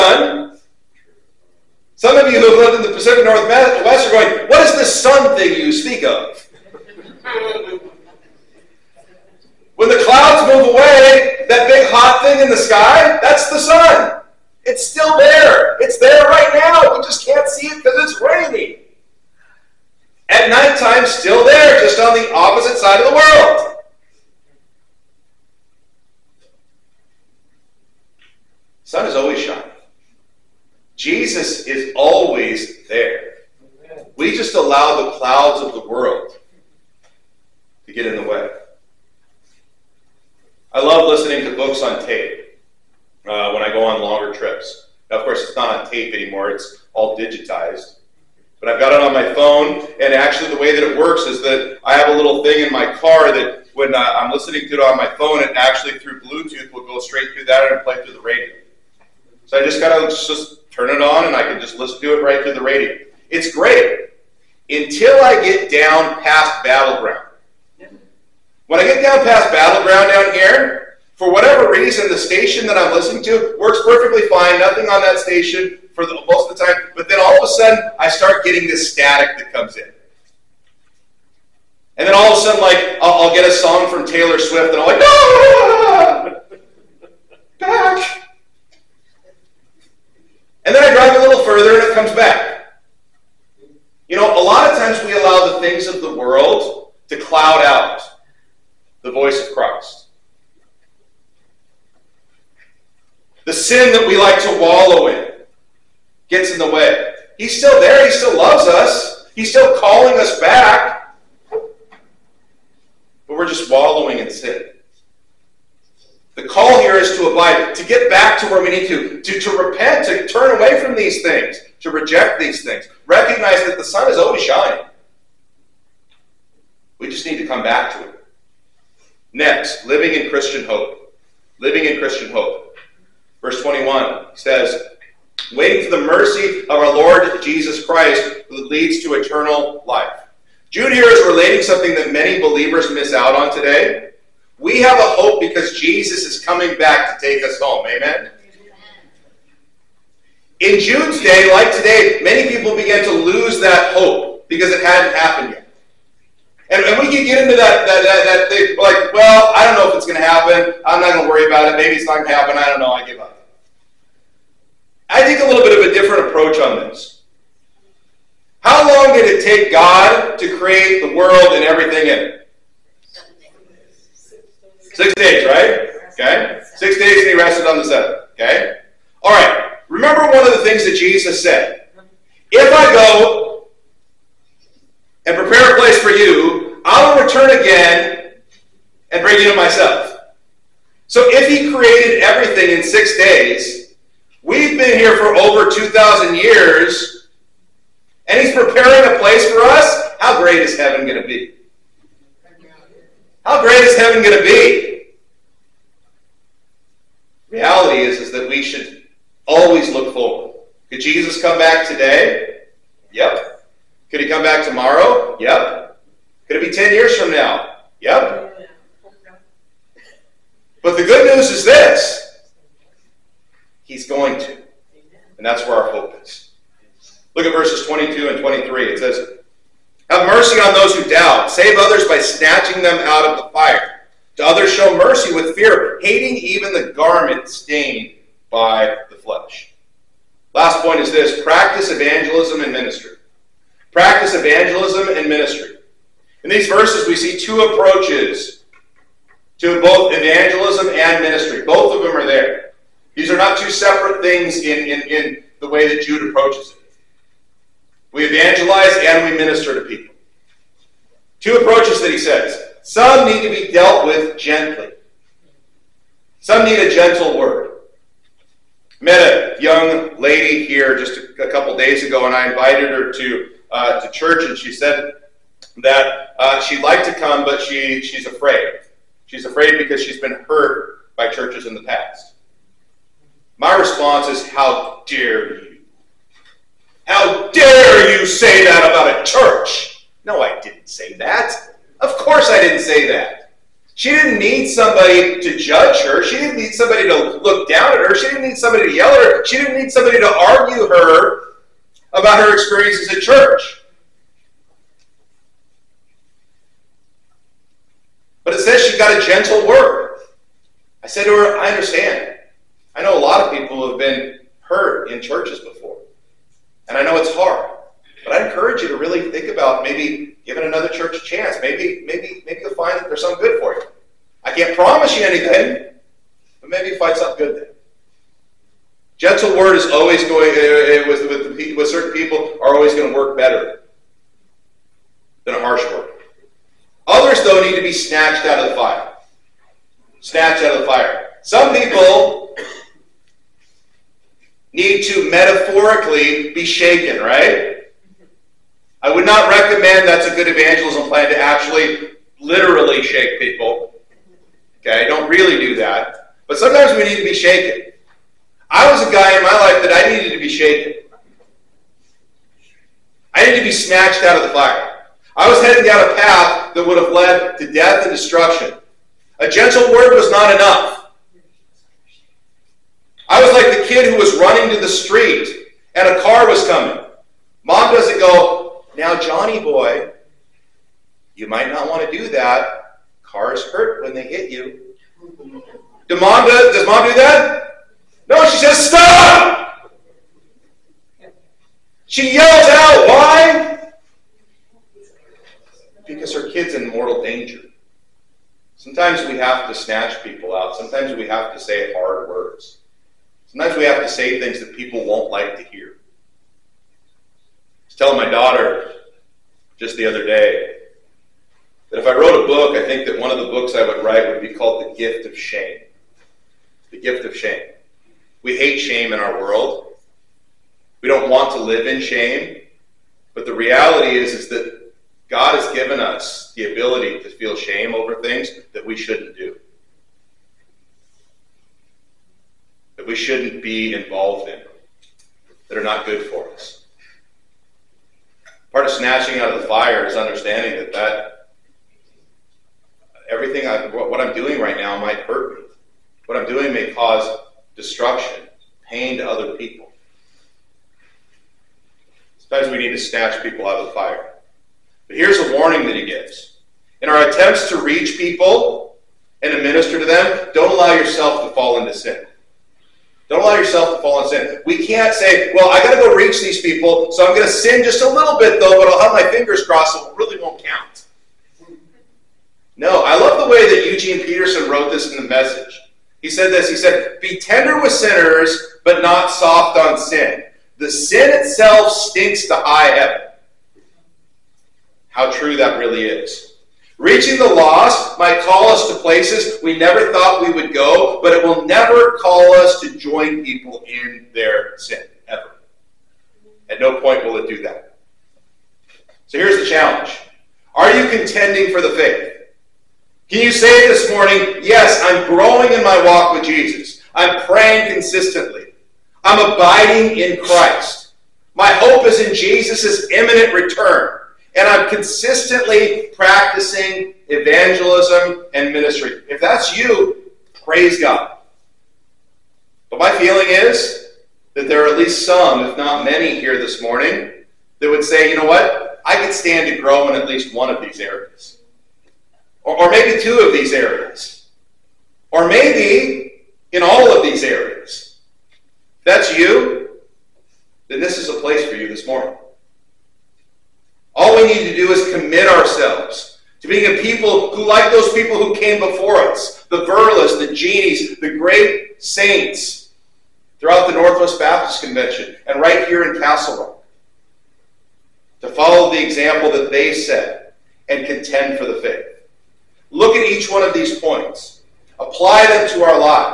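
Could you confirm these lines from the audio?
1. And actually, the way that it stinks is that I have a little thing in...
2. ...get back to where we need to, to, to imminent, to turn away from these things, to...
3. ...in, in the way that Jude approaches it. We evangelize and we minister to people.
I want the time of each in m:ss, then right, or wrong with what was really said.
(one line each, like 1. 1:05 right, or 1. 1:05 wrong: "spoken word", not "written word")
1. 0:49 wrong: "works", not "stinks"
2. 1:57 wrong: "repent", not "imminent"
3. 4:14 right.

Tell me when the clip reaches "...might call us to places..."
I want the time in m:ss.
8:08.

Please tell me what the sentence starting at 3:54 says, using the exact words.
To others show mercy with fear, hating even the garment stained by the flesh.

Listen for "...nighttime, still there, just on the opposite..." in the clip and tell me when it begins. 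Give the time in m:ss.
0:20.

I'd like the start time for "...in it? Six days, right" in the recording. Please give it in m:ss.
2:52.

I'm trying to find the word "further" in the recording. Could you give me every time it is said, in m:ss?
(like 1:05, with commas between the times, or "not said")
1:31.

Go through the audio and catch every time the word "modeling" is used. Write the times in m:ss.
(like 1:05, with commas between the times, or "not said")
not said.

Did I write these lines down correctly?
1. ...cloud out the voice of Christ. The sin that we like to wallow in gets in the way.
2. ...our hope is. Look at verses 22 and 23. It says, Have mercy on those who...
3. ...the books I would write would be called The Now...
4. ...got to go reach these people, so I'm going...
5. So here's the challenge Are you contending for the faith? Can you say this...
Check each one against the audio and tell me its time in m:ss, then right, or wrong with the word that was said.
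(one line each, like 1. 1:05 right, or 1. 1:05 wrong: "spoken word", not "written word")
1. 1:37 right
2. 3:45 right
3. 6:53 wrong: "Gift", not "Now"
4. 7:45 right
5. 8:19 right.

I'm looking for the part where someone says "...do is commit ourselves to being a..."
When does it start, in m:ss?
9:04.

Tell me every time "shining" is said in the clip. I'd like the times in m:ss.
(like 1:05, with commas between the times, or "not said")
0:29, 2:04.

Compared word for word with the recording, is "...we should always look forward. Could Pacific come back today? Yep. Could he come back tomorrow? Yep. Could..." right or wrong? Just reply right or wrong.
wrong.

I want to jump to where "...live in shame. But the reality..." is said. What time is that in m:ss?
7:01.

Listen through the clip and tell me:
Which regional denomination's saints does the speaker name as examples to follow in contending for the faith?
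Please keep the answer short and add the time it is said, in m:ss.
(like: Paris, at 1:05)
Northwest Baptist Convention, at 9:13.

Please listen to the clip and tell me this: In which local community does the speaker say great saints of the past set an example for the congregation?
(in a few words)
Castle Rock.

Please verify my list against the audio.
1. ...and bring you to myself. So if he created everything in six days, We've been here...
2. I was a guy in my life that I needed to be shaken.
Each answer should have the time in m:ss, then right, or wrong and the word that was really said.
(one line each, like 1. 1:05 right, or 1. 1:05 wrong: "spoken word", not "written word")
1. 3:09 right
2. 5:58 right.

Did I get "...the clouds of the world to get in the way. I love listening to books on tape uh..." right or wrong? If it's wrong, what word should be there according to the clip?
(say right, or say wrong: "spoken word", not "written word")
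right.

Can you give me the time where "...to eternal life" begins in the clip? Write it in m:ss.
2:19.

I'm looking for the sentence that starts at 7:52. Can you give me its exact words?
No, I love the way that Eugene Peterson wrote this in the message.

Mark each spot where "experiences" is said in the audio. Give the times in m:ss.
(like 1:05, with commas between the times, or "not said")
5:02.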